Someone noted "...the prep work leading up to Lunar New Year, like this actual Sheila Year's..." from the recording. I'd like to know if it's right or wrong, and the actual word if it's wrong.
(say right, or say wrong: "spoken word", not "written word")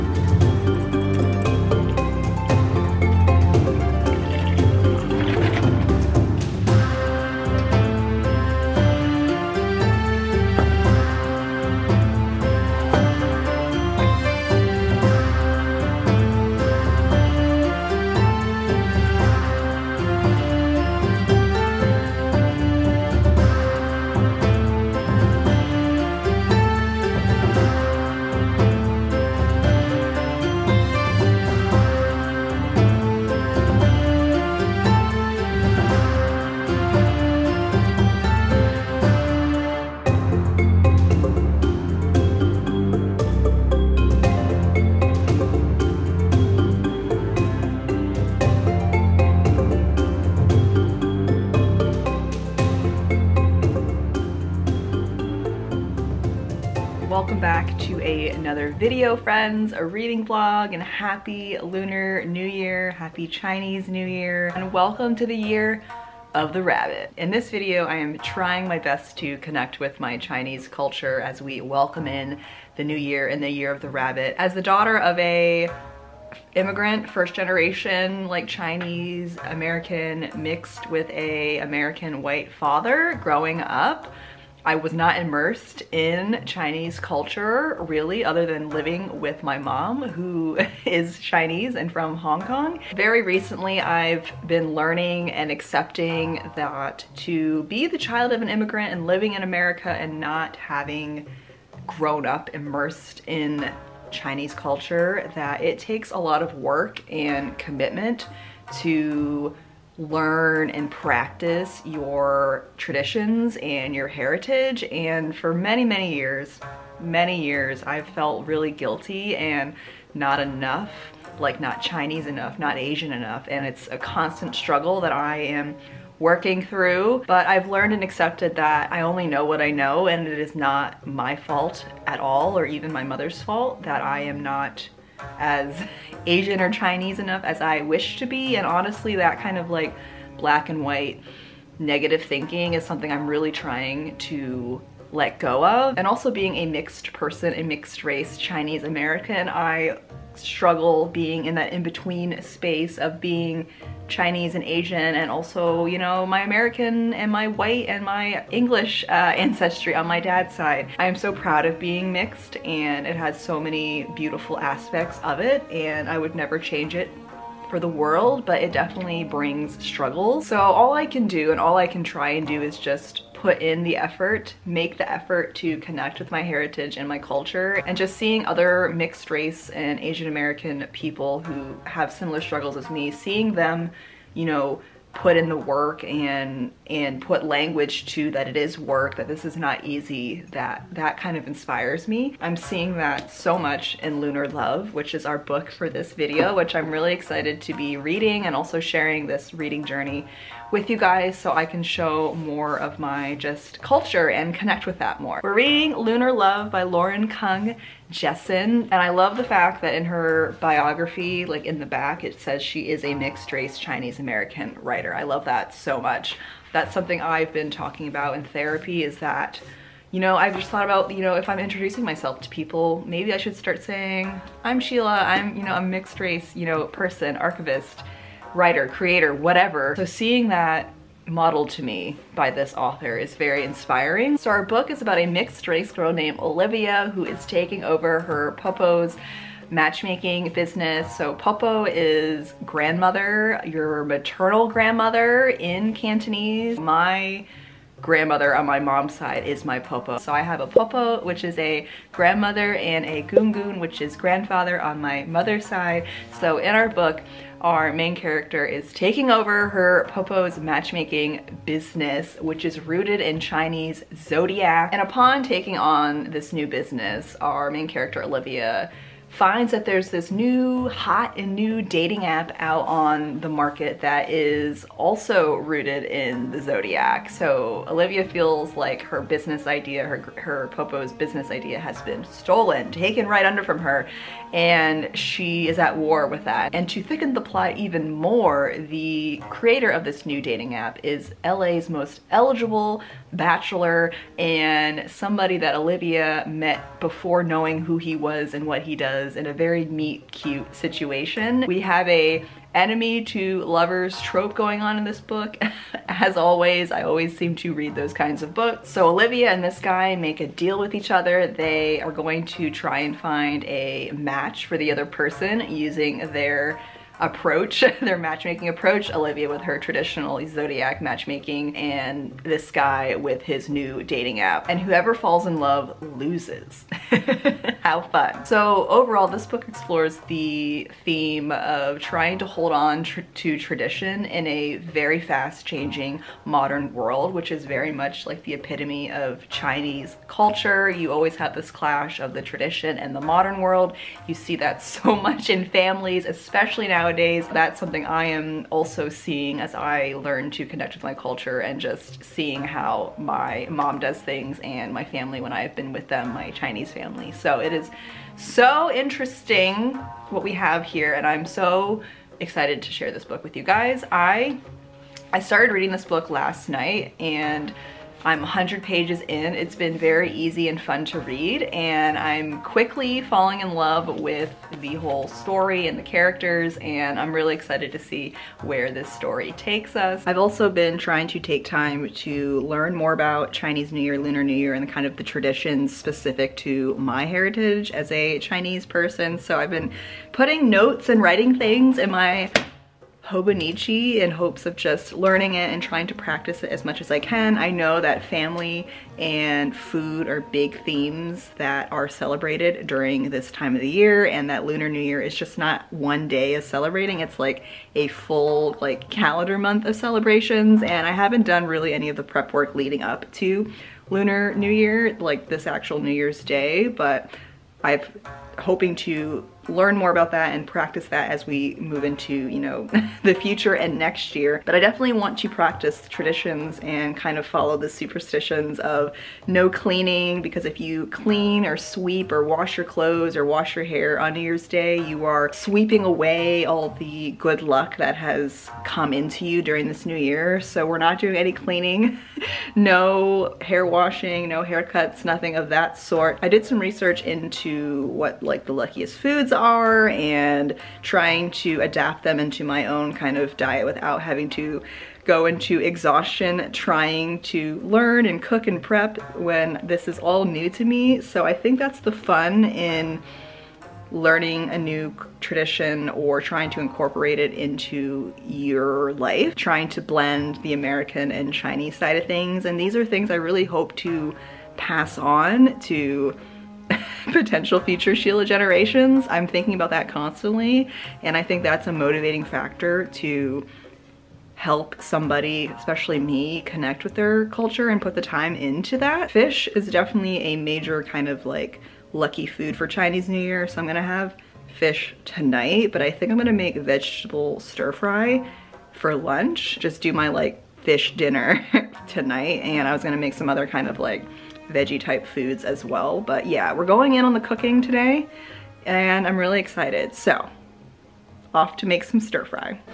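wrong: "New", not "Sheila".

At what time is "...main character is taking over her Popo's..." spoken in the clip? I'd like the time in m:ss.
4:17.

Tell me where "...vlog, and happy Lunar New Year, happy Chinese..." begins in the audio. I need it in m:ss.
1:00.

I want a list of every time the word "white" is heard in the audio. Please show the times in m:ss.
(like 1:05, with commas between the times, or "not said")
1:22, 2:20, 2:37.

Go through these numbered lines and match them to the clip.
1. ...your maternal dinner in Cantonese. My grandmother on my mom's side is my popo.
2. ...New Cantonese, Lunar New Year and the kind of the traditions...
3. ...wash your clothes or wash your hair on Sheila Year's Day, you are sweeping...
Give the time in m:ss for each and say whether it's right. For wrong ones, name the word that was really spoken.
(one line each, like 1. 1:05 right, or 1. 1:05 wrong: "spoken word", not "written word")
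1. 4:03 wrong: "grandmother", not "dinner"
2. 6:23 wrong: "Year", not "Cantonese"
3. 7:12 wrong: "New", not "Sheila".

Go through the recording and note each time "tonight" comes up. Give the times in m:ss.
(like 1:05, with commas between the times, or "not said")
8:15, 8:22.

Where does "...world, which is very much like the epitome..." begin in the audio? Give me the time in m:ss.
5:36.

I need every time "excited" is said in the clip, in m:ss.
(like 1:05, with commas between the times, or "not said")
3:17, 6:02, 6:17, 8:29.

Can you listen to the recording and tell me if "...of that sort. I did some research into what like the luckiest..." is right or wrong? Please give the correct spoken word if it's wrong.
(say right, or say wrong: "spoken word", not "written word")
right.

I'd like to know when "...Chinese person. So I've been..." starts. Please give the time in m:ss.
6:28.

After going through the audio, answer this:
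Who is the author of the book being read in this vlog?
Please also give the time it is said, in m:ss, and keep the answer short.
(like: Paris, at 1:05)
Lauren Kung Jessen, at 3:26.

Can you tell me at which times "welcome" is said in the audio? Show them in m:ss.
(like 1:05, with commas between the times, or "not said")
1:04, 1:11.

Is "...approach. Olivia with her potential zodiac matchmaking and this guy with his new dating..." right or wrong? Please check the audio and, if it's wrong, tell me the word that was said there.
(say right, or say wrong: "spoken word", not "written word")
wrong: "traditional", not "potential".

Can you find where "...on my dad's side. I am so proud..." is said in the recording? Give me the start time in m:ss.
2:39.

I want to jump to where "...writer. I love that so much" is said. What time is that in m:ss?
3:34.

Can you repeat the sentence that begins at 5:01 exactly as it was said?
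We have a enemy to lovers trope going on in this book.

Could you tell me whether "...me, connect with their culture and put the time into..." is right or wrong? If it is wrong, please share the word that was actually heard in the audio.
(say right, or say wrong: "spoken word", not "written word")
right.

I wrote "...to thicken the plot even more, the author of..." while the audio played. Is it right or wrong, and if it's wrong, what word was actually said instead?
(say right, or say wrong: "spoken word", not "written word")
wrong: "creator", not "author".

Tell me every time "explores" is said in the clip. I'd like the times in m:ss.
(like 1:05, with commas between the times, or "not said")
5:29.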